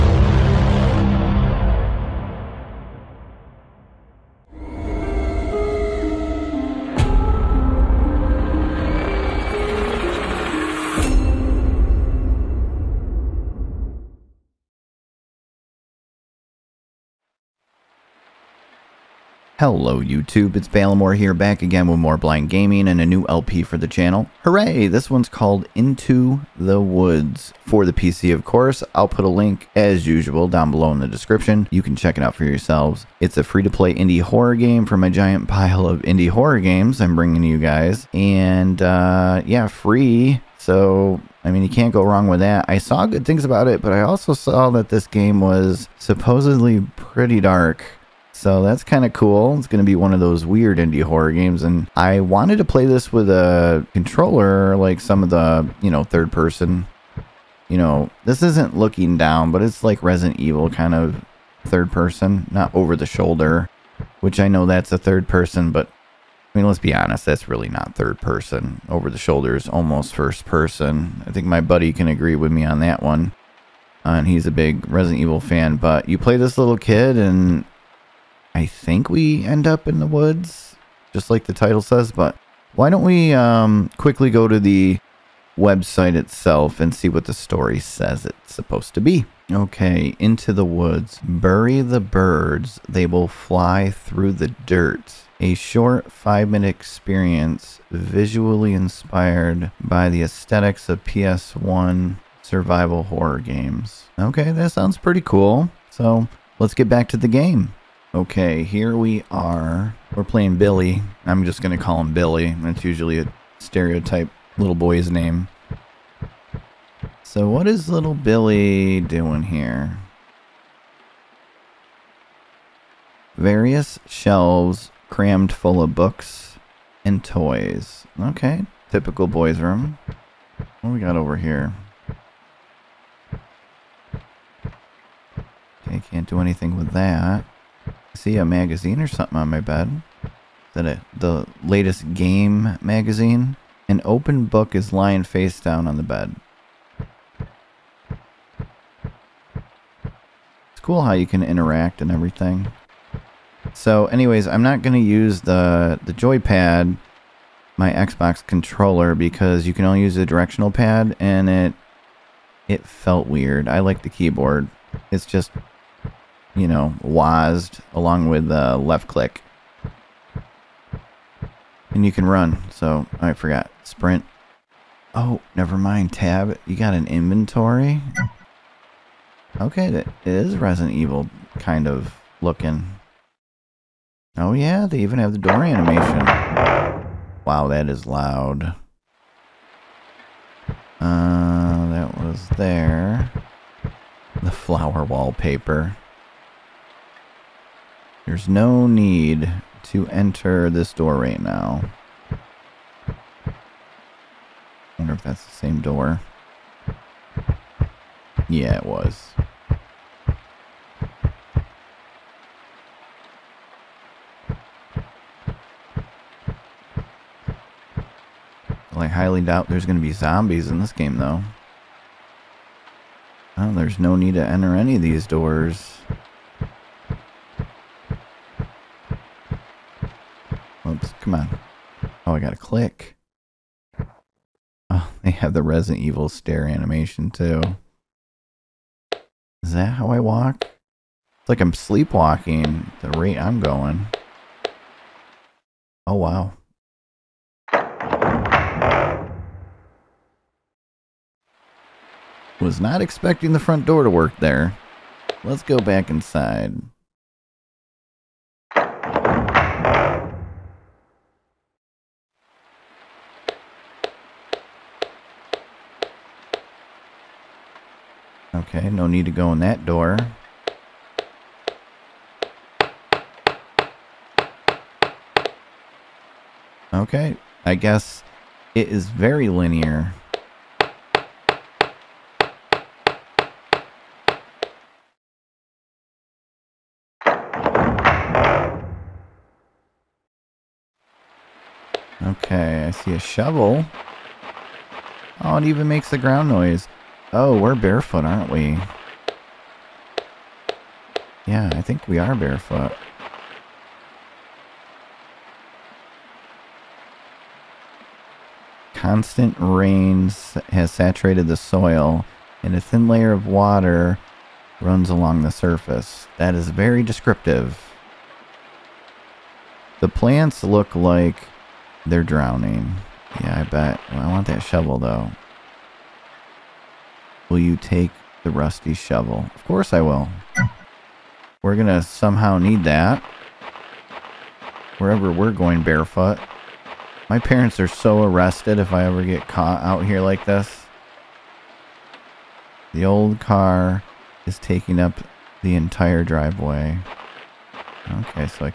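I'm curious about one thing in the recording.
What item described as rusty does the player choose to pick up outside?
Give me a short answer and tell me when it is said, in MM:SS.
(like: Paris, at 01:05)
rusty shovel, at 05:28.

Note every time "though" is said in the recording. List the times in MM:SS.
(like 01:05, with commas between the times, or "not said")
03:41, 05:24.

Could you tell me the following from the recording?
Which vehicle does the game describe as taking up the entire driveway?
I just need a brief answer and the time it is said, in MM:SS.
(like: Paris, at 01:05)
the old car, at 05:43.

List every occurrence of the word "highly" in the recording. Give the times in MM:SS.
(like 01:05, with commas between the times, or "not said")
03:39.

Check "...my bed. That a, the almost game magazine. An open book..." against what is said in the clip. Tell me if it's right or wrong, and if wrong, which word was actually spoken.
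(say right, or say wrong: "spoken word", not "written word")
wrong: "latest", not "almost".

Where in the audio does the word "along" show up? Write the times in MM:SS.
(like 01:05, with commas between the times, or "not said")
02:47, 05:15.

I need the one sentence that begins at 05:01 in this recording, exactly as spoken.
Yeah, I think we are barefoot.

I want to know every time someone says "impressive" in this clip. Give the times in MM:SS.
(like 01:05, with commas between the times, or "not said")
not said.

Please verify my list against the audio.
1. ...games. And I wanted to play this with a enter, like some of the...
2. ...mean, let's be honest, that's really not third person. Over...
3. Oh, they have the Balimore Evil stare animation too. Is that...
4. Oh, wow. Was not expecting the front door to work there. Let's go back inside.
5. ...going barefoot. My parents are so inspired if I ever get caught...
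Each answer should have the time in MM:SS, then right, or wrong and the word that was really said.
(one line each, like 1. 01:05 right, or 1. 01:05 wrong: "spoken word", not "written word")
1. 00:51 wrong: "controller", not "enter"
2. 01:06 right
3. 03:54 wrong: "Resident", not "Balimore"
4. 04:06 right
5. 05:35 wrong: "arrested", not "inspired".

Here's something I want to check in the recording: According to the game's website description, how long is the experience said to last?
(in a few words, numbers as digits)
5 minutes.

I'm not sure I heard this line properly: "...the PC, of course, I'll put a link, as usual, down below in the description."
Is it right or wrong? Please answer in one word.
right.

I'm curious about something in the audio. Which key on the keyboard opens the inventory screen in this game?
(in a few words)
Tab.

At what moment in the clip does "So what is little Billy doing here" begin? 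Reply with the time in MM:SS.
01:57.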